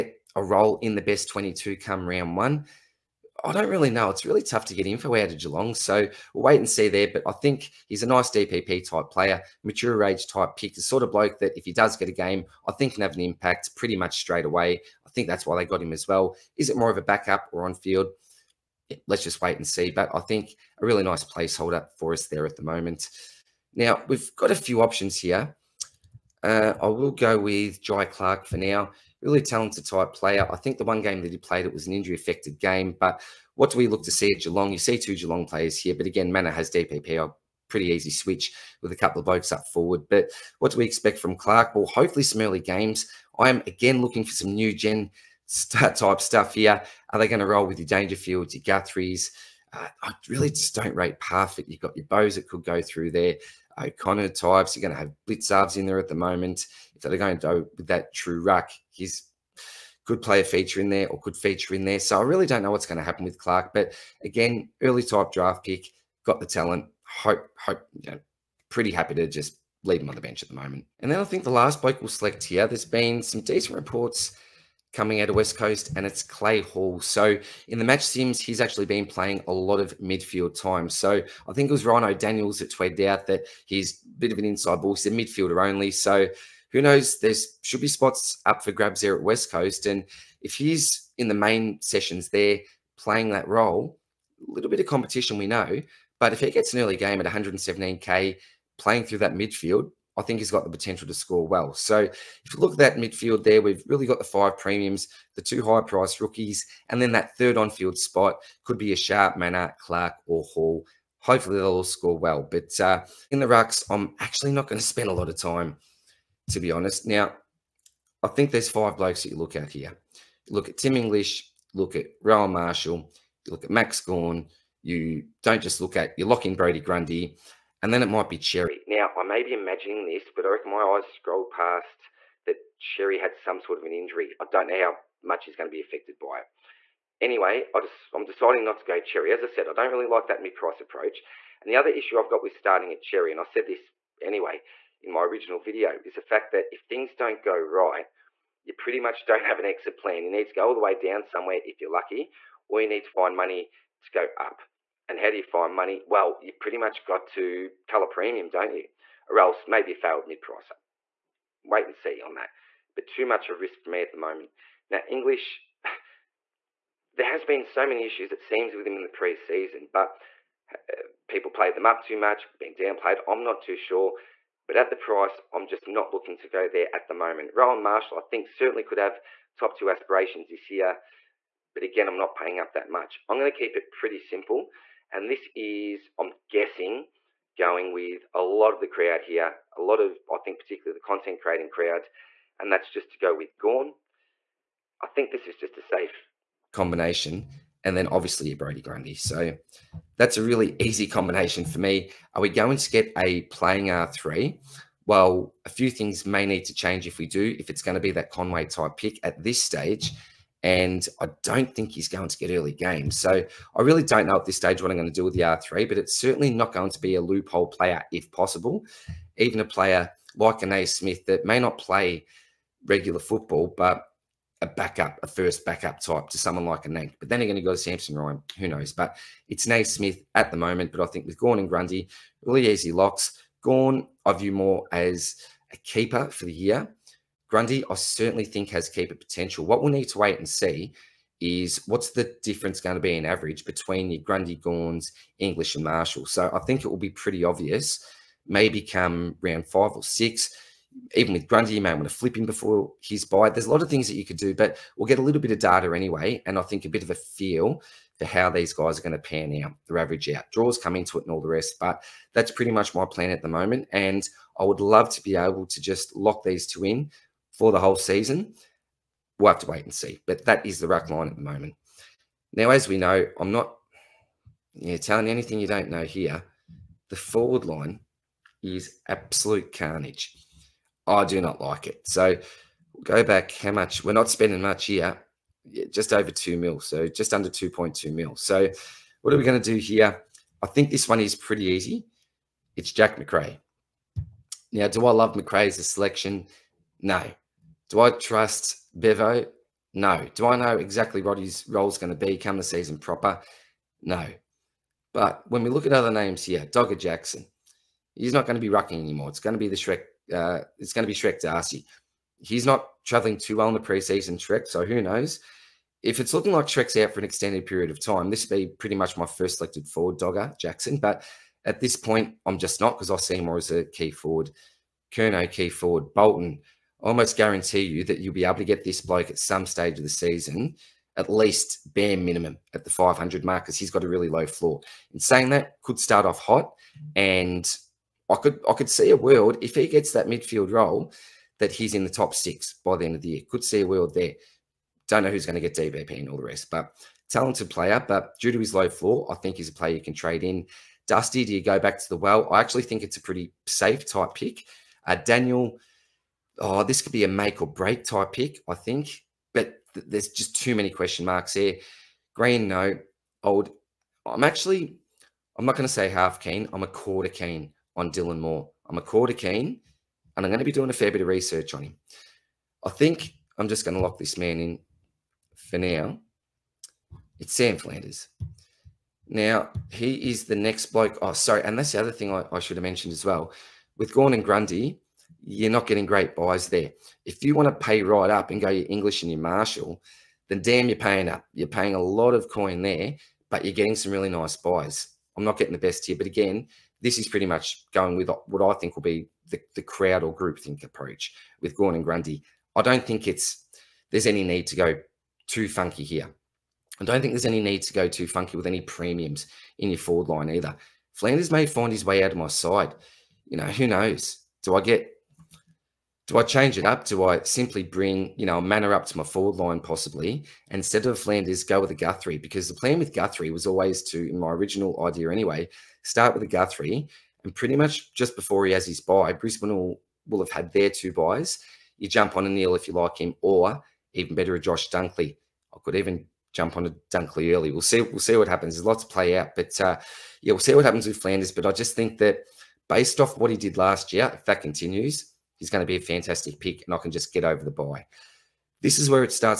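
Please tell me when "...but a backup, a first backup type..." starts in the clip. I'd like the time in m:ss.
3:43.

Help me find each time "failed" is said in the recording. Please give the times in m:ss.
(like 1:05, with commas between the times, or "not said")
2:39.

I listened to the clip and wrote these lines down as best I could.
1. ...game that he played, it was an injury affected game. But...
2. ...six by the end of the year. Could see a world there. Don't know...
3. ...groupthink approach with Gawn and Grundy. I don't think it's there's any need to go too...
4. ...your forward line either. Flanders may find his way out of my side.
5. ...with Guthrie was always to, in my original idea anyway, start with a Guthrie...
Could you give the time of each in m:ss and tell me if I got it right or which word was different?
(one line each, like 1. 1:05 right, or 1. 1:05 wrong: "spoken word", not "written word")
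1. 0:31 right
2. 5:42 right
3. 6:40 right
4. 6:49 right
5. 7:03 right.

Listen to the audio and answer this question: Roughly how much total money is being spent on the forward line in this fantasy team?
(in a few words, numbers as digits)
just under 2.2 mil.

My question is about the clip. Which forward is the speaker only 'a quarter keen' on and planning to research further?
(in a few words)
Dylan Moore.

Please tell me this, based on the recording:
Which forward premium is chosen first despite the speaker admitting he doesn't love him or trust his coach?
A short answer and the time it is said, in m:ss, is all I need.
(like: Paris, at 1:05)
Jack Macrae, at 4:52.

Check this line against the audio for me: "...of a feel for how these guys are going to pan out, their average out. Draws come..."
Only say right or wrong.
right.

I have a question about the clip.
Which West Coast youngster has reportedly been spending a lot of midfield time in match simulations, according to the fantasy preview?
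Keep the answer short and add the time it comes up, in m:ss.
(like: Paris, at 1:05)
Clay Hall, at 1:16.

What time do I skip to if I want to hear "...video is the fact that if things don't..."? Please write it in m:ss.
2:25.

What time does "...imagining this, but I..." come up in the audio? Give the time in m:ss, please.
2:09.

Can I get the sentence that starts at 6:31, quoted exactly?
You're paying a lot of coin there, but you're getting some really nice buys.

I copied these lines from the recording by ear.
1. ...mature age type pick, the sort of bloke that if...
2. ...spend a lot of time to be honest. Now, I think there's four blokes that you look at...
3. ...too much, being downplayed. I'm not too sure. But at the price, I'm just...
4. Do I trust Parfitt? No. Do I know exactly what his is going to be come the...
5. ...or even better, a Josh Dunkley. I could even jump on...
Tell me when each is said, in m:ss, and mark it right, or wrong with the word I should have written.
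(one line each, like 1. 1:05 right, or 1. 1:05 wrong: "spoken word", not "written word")
1. 0:09 right
2. 1:54 wrong: "five", not "four"
3. 2:52 right
4. 4:57 wrong: "Bevo", not "Parfitt"
5. 7:13 right.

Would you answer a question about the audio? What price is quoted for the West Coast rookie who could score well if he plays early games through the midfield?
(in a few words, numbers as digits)
117k.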